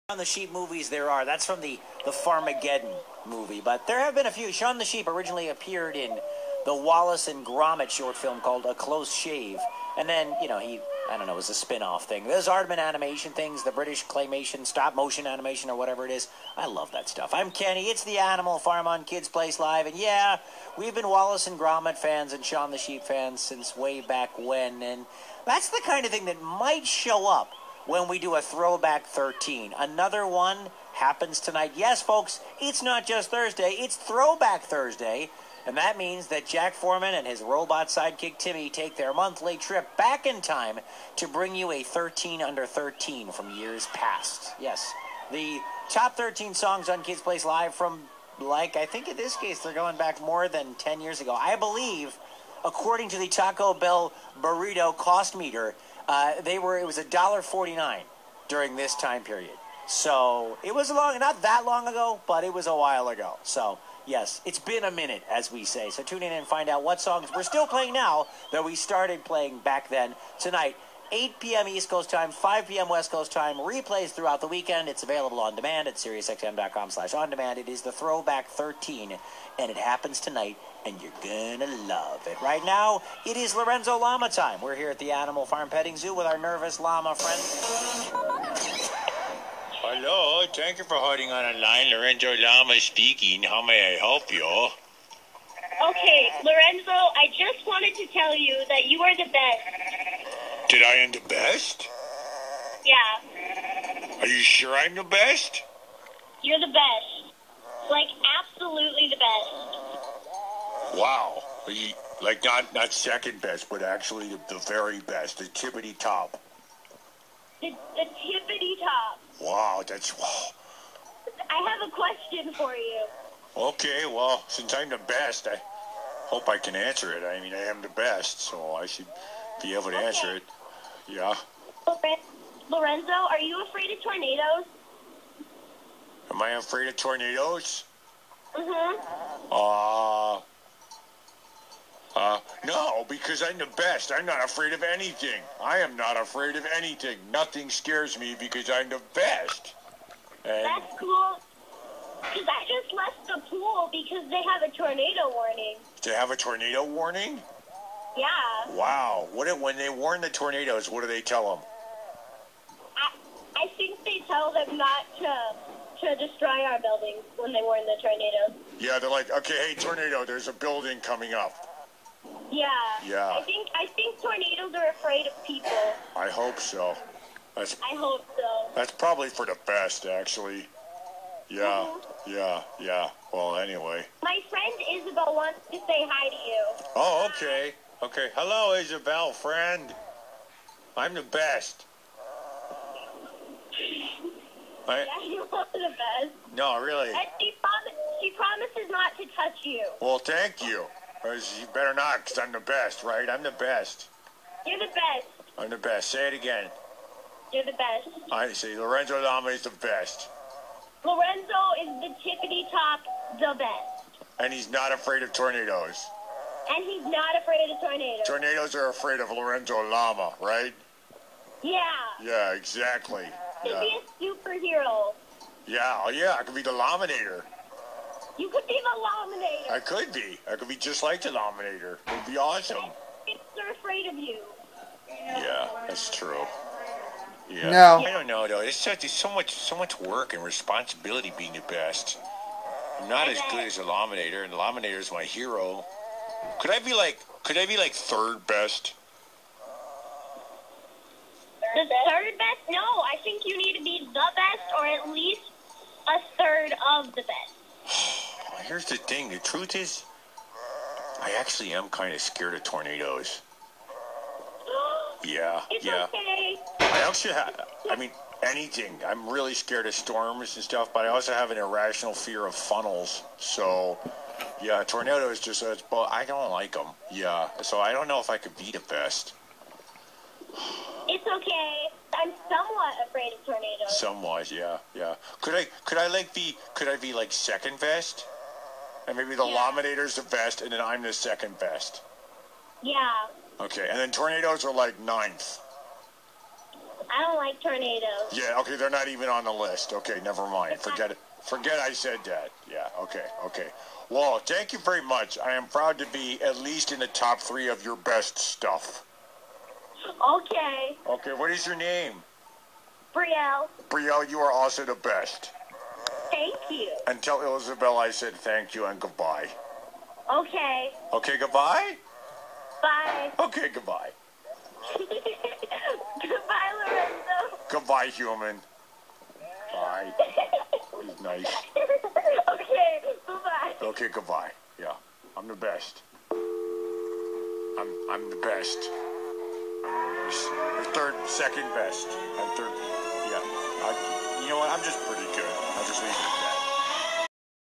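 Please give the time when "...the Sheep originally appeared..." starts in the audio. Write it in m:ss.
0:04.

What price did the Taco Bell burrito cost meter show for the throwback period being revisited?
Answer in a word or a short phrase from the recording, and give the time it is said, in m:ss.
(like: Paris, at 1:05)
$1.49, at 0:56.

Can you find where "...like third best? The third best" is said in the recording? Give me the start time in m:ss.
4:07.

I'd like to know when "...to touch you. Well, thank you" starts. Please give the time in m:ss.
3:19.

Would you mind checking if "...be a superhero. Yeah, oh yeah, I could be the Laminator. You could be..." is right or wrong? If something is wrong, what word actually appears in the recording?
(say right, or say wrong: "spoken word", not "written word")
right.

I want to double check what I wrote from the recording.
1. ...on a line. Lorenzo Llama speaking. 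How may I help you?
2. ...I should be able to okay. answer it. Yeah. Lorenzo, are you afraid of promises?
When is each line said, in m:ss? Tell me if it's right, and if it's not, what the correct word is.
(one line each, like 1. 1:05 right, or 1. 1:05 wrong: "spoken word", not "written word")
1. 1:31 right
2. 2:08 wrong: "tornadoes", not "promises".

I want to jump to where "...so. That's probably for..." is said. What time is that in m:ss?
2:58.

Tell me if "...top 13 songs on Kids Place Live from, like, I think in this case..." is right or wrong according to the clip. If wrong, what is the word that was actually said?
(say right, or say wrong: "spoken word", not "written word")
right.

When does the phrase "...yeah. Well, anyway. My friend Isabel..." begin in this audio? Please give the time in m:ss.
3:02.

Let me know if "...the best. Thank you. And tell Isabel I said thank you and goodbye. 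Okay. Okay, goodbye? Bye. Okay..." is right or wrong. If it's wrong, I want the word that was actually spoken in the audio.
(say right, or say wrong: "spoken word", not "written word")
right.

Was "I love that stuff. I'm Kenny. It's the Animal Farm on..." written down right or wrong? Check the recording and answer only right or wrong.
right.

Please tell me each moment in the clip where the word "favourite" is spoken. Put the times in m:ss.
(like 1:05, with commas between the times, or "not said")
not said.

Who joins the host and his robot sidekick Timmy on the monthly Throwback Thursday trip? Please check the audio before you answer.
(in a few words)
Jack Forman.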